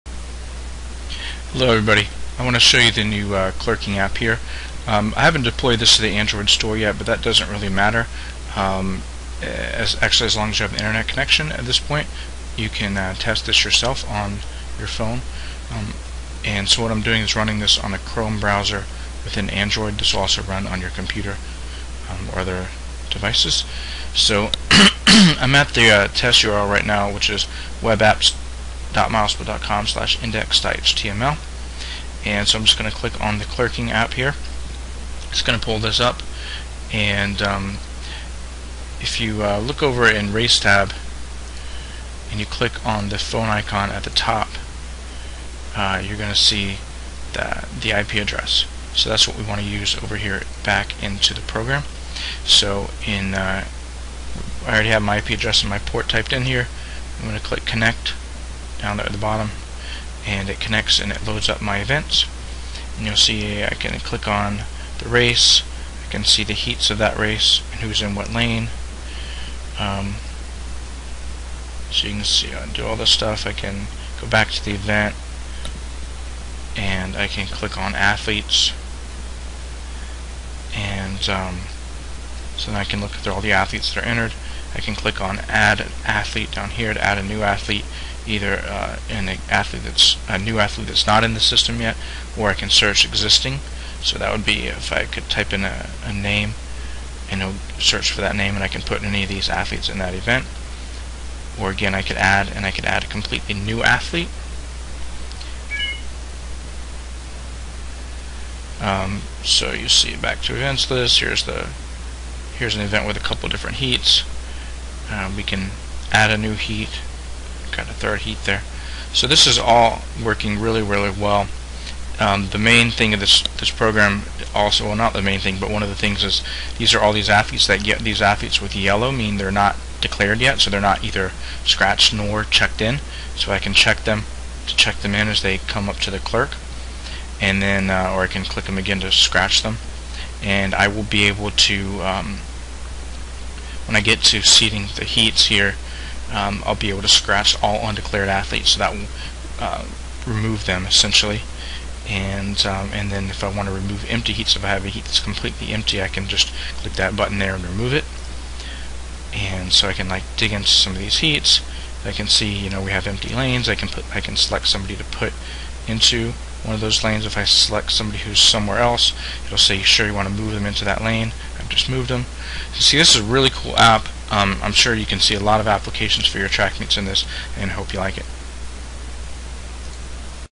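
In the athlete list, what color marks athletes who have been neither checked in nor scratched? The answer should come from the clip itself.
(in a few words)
Yellow.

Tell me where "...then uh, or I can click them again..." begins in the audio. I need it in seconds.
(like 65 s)
137 s.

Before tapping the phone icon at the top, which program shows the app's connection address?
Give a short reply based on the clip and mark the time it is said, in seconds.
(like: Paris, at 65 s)
RaceTab, at 40 s.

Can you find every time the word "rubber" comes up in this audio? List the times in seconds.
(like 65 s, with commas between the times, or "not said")
not said.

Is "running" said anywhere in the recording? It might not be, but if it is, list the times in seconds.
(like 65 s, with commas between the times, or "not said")
17 s.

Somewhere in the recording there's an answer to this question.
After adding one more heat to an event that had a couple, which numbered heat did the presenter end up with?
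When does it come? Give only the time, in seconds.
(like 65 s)
117 s.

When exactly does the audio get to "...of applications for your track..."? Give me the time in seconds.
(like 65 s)
175 s.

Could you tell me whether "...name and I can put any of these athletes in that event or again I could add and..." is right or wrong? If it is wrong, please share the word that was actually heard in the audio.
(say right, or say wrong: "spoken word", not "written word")
right.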